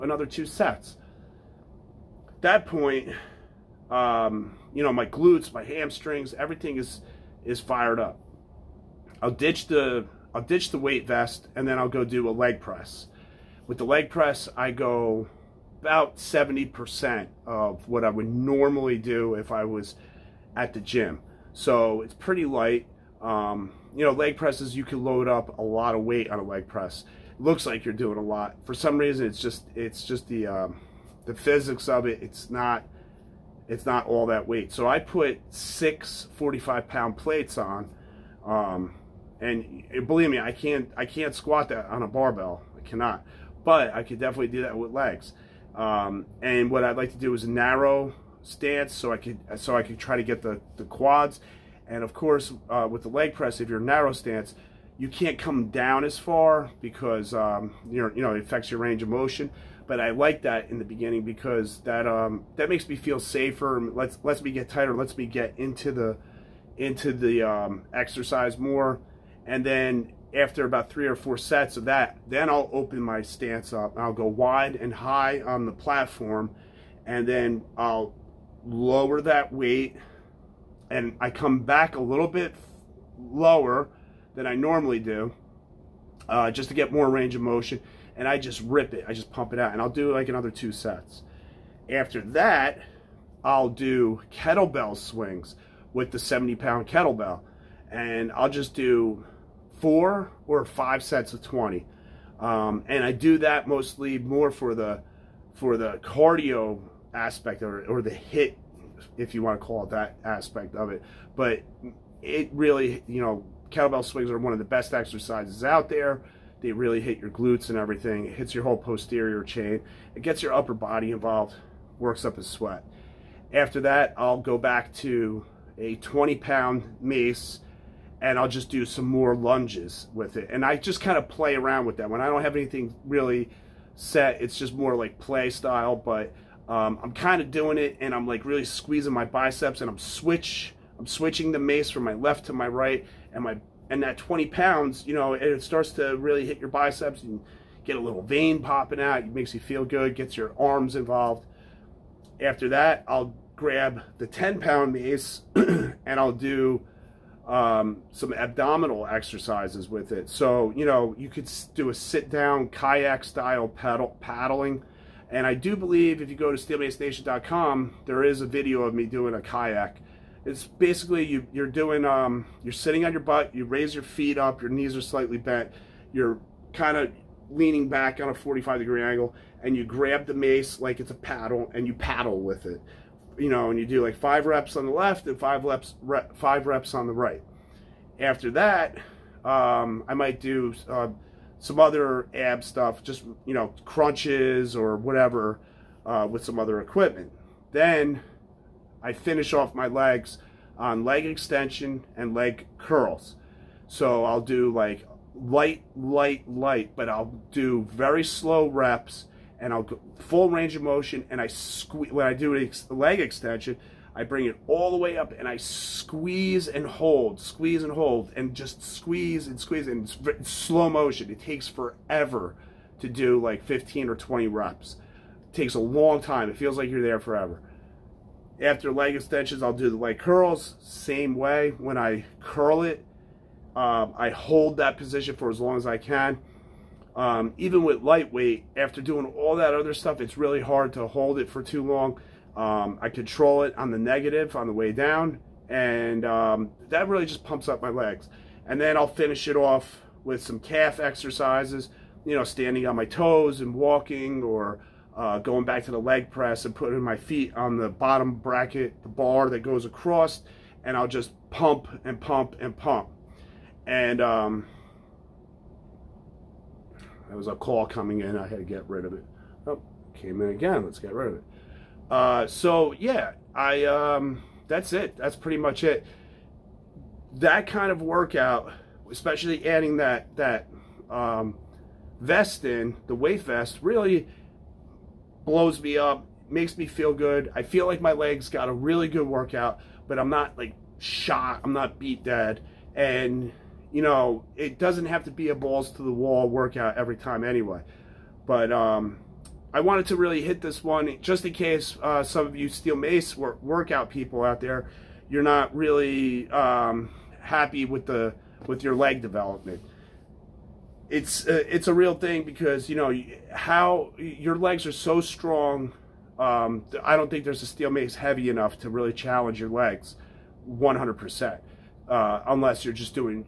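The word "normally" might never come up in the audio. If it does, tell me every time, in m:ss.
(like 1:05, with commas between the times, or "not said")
0:18, 1:24.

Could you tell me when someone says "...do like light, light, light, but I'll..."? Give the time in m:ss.
3:24.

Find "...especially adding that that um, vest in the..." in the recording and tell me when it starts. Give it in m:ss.
4:39.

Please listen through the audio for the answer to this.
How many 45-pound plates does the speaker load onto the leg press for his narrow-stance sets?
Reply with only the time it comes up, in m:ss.
0:35.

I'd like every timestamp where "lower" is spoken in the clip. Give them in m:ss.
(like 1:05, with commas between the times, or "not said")
1:18, 1:23.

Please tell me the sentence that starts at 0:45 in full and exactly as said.
Um, and what I'd like to do is narrow stance so I could so I could try to get the, the quads.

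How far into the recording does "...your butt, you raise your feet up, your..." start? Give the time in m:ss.
2:53.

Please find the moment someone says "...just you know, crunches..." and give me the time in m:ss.
3:13.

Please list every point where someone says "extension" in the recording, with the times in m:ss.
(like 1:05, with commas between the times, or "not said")
3:21, 3:33, 3:49.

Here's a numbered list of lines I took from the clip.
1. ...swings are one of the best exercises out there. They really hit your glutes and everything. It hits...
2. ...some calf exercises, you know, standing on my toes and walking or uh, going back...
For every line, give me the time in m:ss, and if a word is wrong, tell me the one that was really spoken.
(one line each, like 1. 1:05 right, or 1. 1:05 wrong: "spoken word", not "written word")
1. 1:54 right
2. 4:10 right.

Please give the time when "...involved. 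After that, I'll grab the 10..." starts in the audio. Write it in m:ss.
2:30.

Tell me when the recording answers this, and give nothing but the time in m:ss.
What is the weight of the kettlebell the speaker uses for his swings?
1:36.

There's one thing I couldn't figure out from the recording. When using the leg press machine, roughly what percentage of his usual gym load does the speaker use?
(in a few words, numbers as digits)
70%.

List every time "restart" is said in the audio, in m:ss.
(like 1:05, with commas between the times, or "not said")
not said.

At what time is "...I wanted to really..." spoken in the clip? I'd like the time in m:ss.
4:59.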